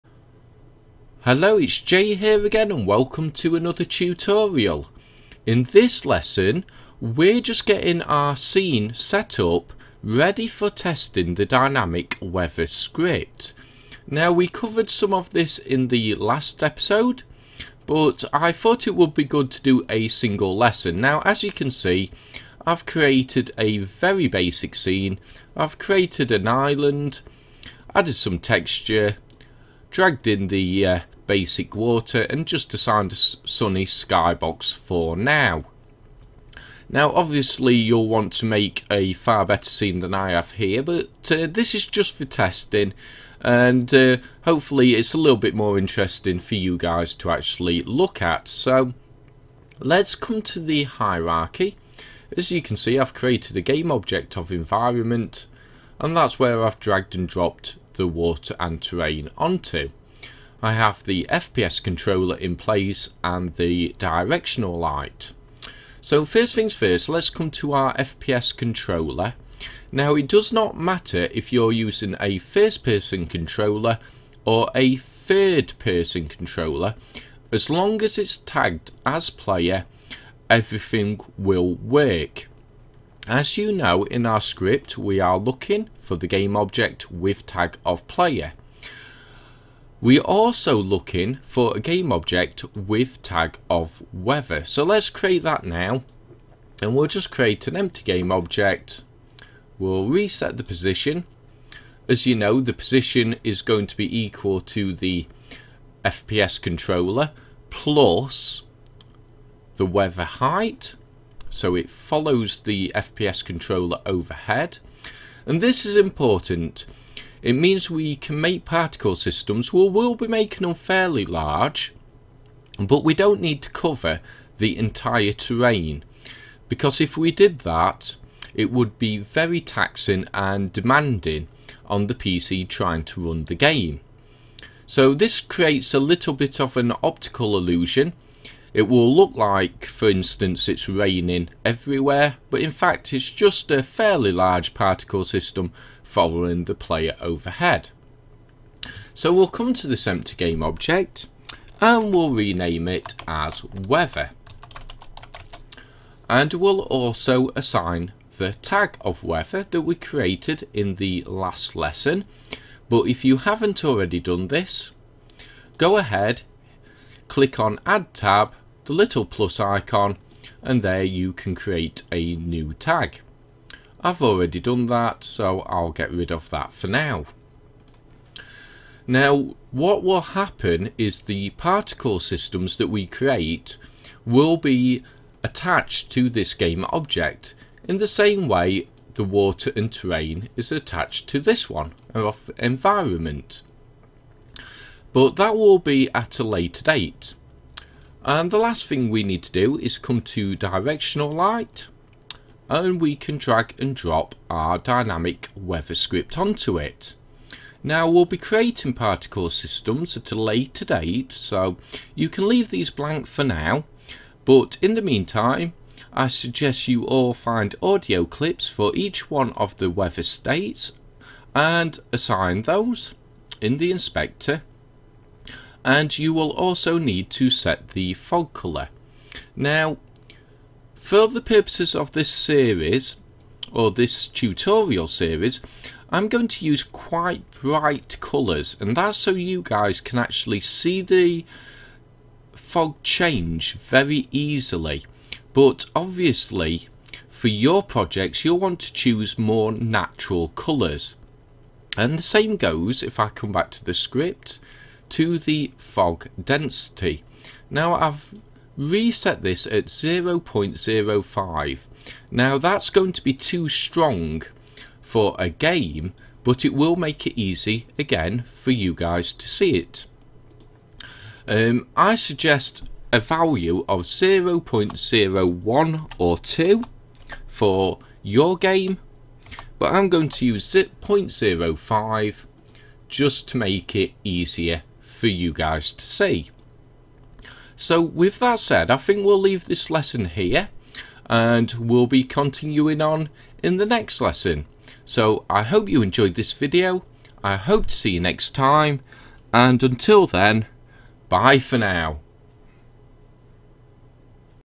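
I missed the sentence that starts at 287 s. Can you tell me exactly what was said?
So with that said, I think we'll leave this lesson here and we'll be continuing on in the next lesson.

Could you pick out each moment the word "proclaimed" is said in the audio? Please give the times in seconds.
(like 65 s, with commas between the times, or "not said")
not said.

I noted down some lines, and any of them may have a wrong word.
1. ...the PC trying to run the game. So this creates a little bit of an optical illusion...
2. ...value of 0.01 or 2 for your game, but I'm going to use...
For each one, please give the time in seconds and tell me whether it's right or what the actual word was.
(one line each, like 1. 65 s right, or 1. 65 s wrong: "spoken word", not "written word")
1. 132 s right
2. 273 s right.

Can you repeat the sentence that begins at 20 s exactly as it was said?
Now, as you can see, I've created a very basic scene.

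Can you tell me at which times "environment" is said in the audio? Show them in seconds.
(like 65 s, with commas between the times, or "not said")
54 s, 192 s.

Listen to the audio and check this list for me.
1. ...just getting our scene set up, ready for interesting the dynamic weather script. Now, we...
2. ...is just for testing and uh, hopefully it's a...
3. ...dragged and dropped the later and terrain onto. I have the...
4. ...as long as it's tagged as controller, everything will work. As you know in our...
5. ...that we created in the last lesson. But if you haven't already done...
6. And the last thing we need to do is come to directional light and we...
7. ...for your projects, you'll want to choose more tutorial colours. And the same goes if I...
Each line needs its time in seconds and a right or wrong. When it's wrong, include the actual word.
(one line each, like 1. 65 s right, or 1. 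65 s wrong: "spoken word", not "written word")
1. 7 s wrong: "testing", not "interesting"
2. 41 s right
3. 56 s wrong: "water", not "later"
4. 77 s wrong: "player", not "controller"
5. 159 s right
6. 198 s right
7. 247 s wrong: "natural", not "tutorial".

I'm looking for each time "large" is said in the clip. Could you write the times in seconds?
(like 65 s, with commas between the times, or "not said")
121 s, 144 s.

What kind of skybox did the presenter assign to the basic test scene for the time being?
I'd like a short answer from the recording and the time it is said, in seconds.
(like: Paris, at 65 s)
sunny, at 33 s.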